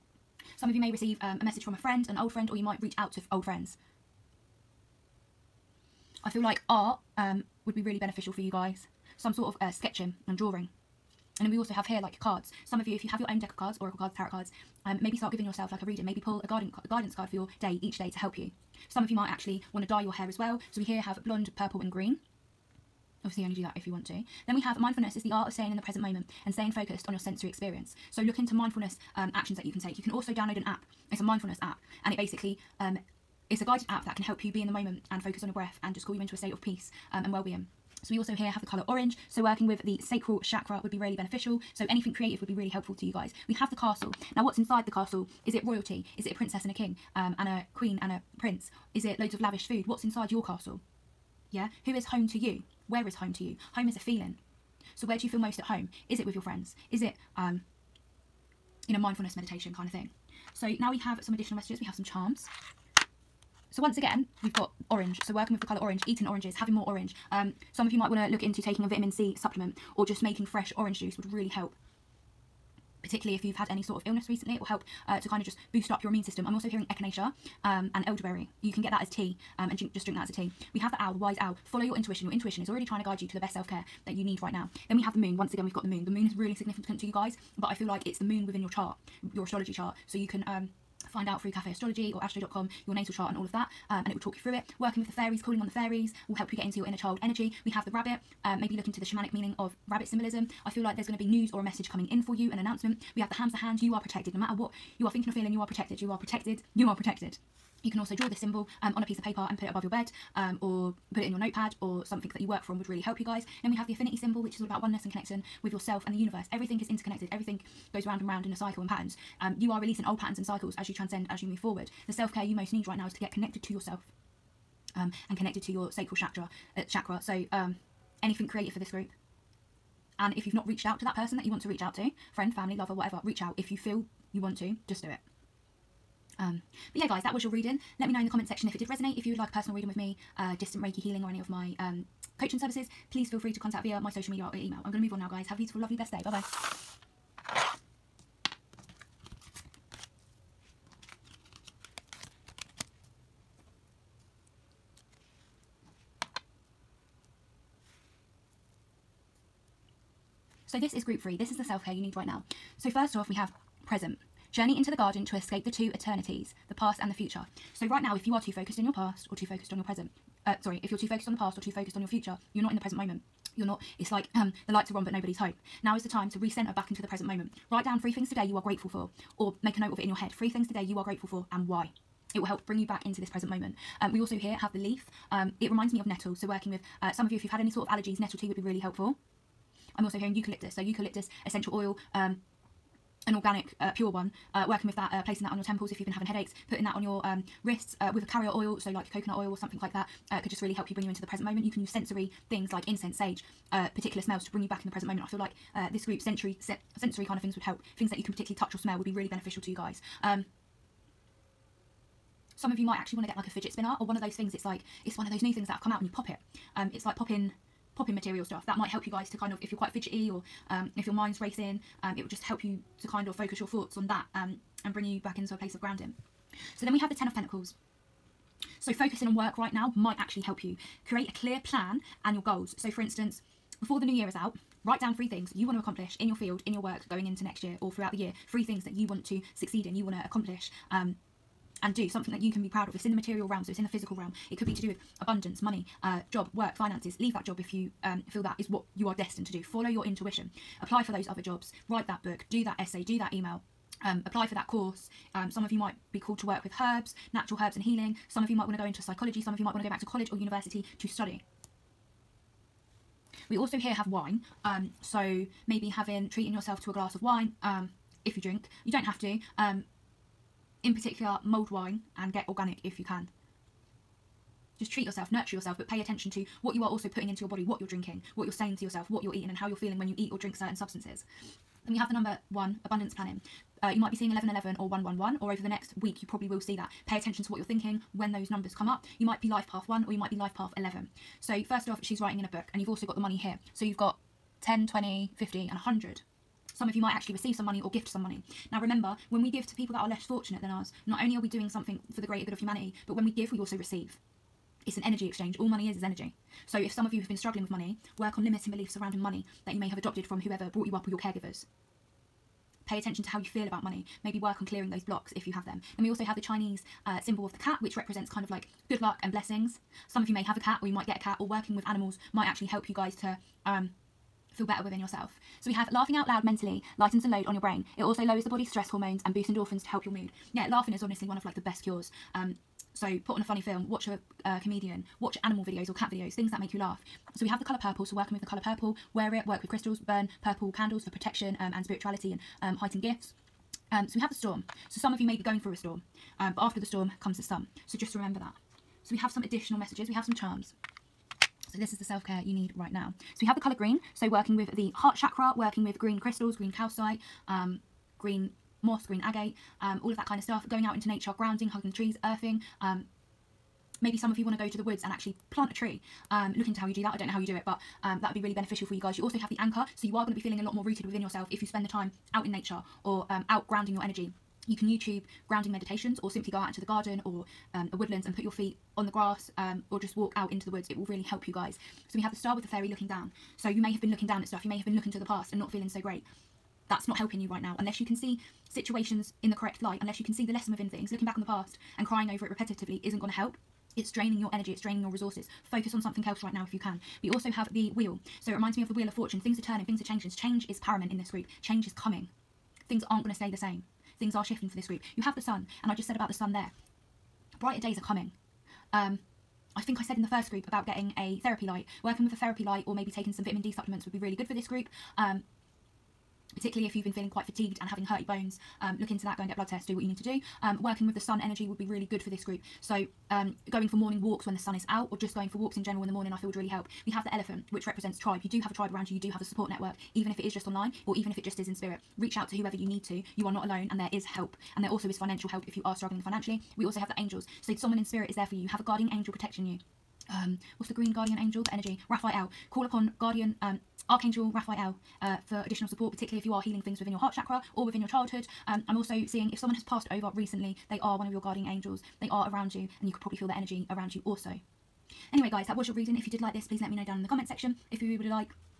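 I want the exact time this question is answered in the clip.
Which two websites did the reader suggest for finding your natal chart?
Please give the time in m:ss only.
1:31.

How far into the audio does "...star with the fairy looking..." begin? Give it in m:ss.
6:22.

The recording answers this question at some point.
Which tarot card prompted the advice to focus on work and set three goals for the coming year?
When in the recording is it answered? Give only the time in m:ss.
3:47.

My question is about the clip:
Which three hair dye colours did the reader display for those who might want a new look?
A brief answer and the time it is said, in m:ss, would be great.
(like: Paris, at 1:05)
blonde, purple and green, at 0:21.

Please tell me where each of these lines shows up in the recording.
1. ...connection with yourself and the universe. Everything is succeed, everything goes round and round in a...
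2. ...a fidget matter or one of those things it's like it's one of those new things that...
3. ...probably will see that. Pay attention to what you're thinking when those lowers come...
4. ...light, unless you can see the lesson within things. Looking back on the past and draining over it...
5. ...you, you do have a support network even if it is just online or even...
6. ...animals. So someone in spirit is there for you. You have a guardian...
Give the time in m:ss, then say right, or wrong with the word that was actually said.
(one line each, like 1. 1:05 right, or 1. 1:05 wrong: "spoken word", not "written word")
1. 1:55 wrong: "interconnected", not "succeed"
2. 3:33 wrong: "spinner", not "matter"
3. 4:46 wrong: "numbers", not "lowers"
4. 6:29 wrong: "crying", not "draining"
5. 7:09 right
6. 7:17 wrong: "angels", not "animals".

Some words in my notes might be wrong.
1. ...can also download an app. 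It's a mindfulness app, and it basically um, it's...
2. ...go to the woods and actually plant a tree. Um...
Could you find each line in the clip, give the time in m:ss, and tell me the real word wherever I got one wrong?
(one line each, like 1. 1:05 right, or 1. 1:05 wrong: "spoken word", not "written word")
1. 0:30 right
2. 6:04 right.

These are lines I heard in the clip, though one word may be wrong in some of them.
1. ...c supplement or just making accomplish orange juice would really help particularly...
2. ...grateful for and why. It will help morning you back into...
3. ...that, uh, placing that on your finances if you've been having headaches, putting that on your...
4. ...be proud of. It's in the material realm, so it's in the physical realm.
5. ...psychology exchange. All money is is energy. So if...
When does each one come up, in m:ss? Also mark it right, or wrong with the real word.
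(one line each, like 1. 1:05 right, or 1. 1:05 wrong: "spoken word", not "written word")
1. 1:09 wrong: "fresh", not "accomplish"
2. 3:01 wrong: "bring", not "morning"
3. 3:14 wrong: "temples", not "finances"
4. 4:02 right
5. 5:05 wrong: "energy", not "psychology".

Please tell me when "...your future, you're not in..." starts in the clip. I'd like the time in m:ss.
2:52.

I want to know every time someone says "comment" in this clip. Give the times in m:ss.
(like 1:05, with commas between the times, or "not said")
2:18, 7:37.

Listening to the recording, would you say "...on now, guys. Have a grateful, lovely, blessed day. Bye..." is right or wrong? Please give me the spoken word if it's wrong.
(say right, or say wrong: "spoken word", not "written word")
wrong: "beautiful", not "grateful".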